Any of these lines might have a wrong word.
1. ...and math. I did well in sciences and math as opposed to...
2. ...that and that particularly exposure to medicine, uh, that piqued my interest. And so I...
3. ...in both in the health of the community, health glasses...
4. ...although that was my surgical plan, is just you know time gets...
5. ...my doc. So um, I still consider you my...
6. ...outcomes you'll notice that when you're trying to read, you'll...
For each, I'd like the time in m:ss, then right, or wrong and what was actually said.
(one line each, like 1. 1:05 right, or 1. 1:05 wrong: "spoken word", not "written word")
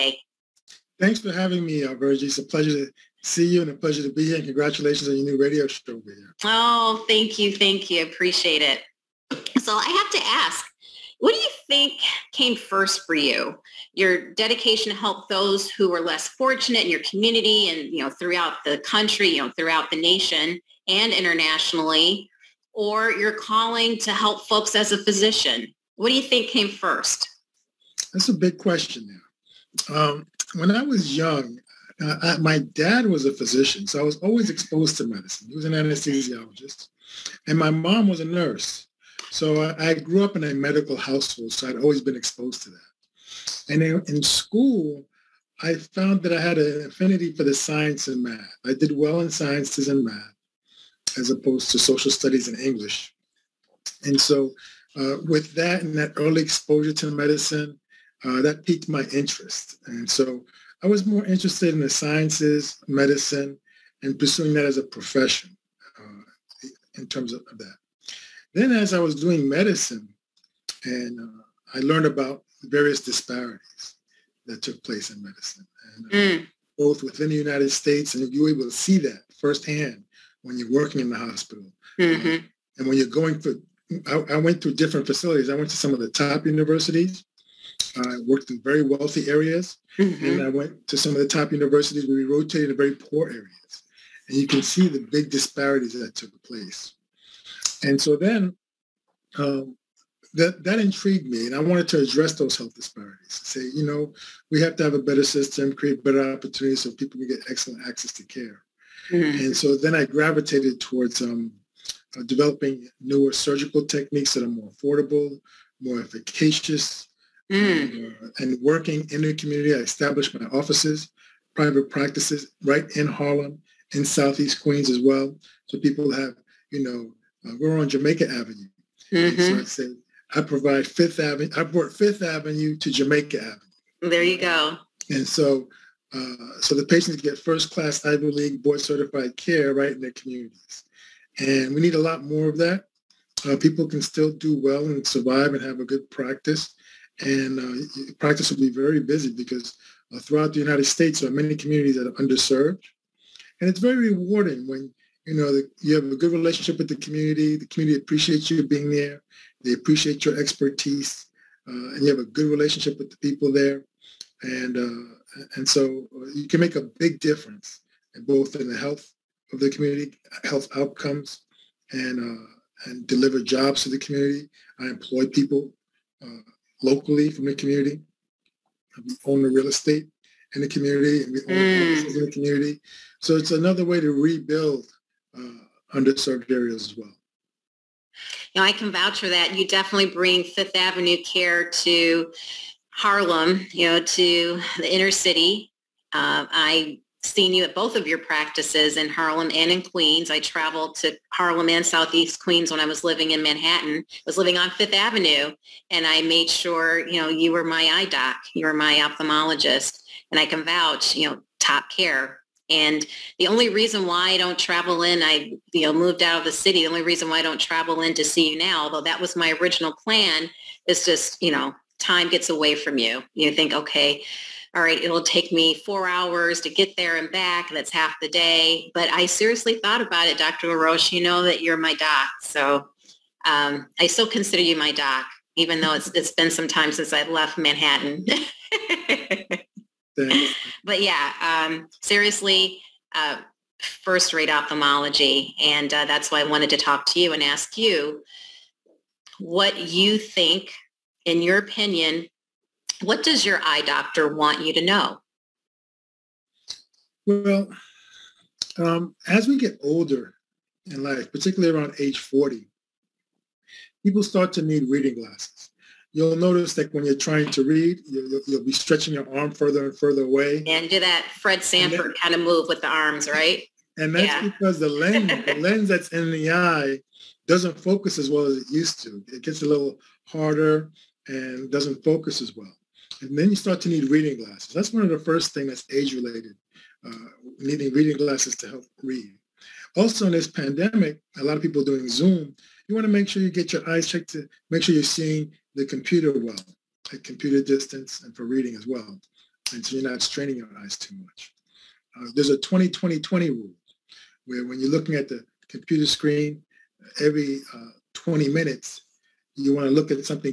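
1. 0:48 right
2. 0:55 wrong: "early", not "particularly"
3. 2:48 wrong: "outcomes", not "glasses"
4. 3:38 wrong: "original", not "surgical"
5. 3:51 right
6. 4:25 wrong: "glasses", not "outcomes".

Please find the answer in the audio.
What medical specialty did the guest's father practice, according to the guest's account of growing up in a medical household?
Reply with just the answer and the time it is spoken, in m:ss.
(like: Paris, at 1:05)
anesthesiologist, at 0:35.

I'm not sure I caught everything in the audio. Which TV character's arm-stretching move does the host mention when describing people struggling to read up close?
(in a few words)
Fred Sanford.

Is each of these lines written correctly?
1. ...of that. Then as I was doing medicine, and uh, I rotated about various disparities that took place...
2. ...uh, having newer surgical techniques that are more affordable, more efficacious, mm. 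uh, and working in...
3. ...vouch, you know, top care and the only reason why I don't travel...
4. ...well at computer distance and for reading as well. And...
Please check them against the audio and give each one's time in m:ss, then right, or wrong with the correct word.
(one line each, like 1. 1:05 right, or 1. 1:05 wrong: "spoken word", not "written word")
1. 1:07 wrong: "learned", not "rotated"
2. 1:52 wrong: "developing", not "having"
3. 3:30 right
4. 4:56 right.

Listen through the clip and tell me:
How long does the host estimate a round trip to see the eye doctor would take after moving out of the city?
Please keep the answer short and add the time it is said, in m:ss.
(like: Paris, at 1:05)
4 hours, at 3:45.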